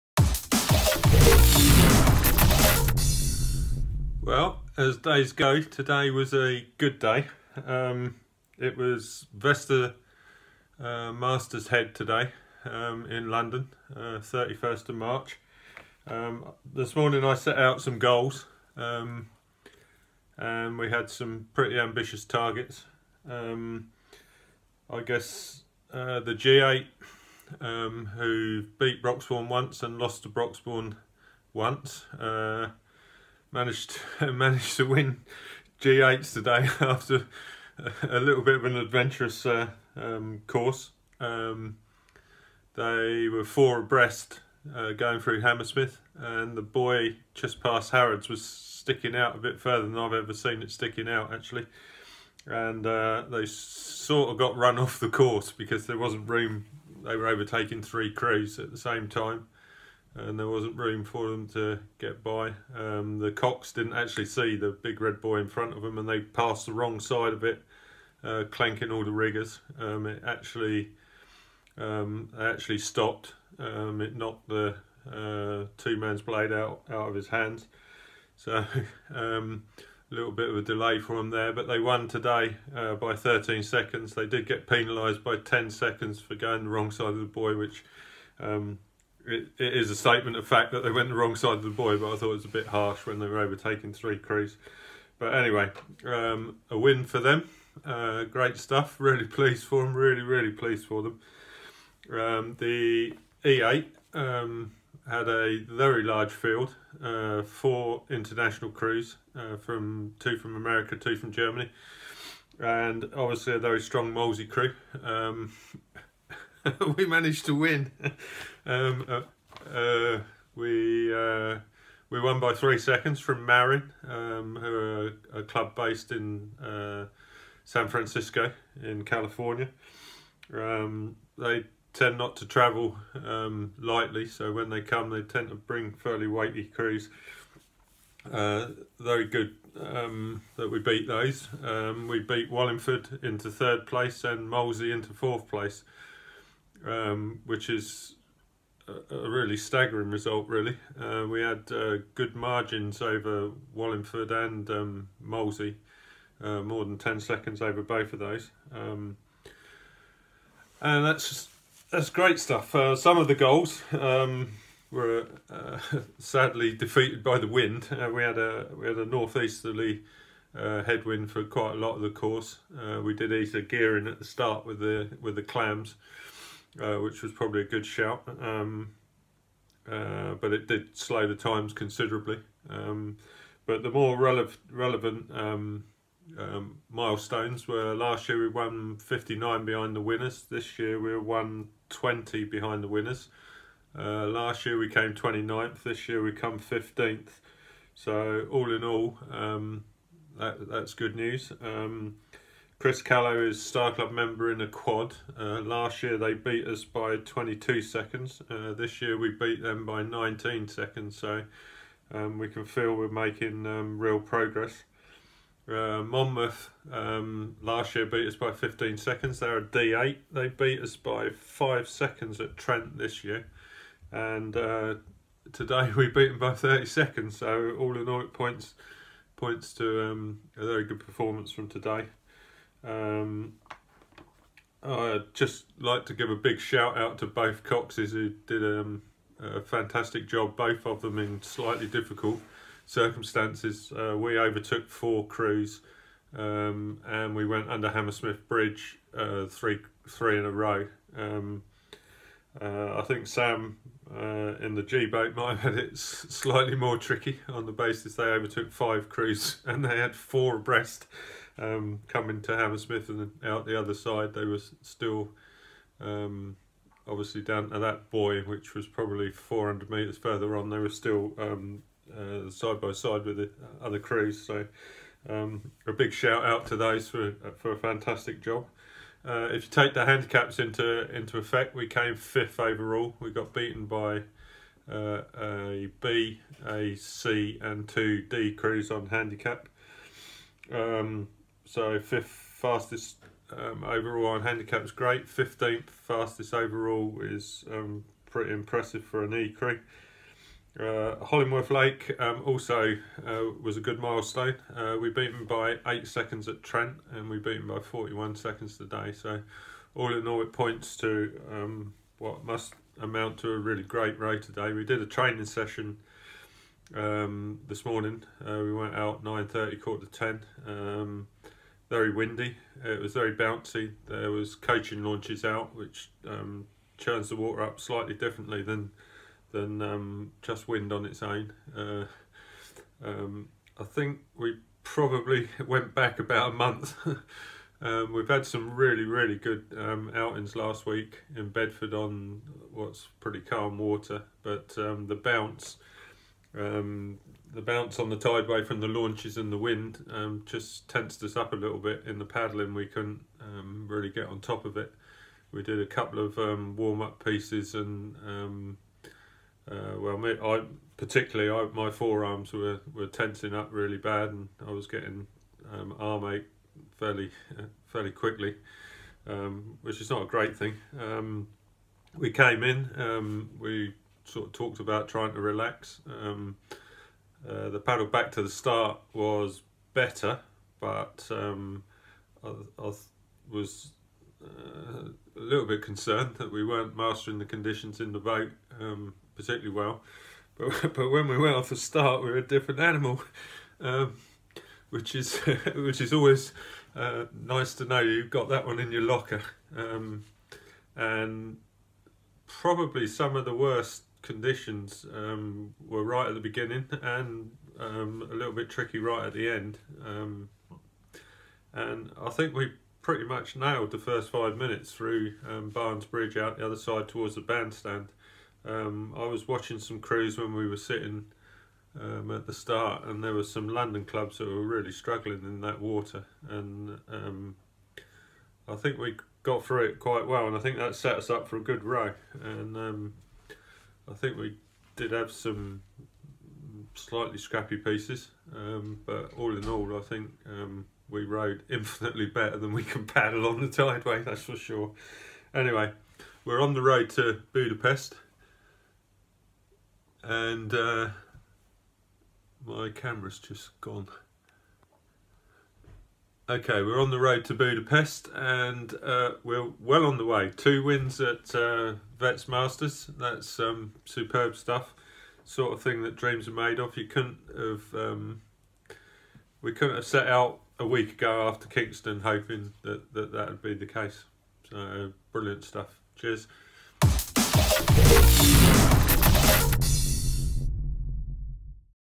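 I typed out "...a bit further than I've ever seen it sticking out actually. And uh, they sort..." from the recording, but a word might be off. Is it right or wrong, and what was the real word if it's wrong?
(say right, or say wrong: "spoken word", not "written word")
right.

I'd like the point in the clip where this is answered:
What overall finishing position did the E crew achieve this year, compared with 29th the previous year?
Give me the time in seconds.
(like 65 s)
196 s.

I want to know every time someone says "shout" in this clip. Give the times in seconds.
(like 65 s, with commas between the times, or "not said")
177 s, 236 s, 276 s.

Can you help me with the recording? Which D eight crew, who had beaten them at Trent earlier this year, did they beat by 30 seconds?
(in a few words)
Monmouth.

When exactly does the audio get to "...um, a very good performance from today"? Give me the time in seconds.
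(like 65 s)
230 s.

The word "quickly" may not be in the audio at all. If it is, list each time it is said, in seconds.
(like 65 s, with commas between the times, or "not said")
368 s.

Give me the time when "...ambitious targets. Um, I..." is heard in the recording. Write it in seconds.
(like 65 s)
21 s.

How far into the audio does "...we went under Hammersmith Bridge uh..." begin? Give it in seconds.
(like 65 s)
247 s.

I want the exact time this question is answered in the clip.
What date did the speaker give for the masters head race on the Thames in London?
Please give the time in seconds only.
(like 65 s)
14 s.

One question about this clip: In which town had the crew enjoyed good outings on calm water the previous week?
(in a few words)
Bedford.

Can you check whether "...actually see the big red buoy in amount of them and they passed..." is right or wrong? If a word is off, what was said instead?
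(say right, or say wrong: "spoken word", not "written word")
wrong: "front", not "amount".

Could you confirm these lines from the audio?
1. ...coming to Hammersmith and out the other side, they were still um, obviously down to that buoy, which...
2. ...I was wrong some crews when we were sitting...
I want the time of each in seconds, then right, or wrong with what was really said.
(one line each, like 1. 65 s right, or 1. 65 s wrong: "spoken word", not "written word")
1. 262 s right
2. 419 s wrong: "watching", not "wrong".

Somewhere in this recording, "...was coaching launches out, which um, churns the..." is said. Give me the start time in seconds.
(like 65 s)
324 s.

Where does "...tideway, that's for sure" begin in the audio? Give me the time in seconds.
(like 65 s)
443 s.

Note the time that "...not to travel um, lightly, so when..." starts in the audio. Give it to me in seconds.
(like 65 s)
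132 s.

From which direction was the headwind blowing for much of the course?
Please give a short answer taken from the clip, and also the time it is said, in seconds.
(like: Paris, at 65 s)
Northeasterly, at 169 s.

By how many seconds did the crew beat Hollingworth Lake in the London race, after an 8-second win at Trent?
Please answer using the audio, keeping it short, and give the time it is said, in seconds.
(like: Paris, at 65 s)
41 seconds, at 307 s.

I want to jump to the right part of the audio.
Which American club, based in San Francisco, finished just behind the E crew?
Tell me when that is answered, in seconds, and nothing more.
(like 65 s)
123 s.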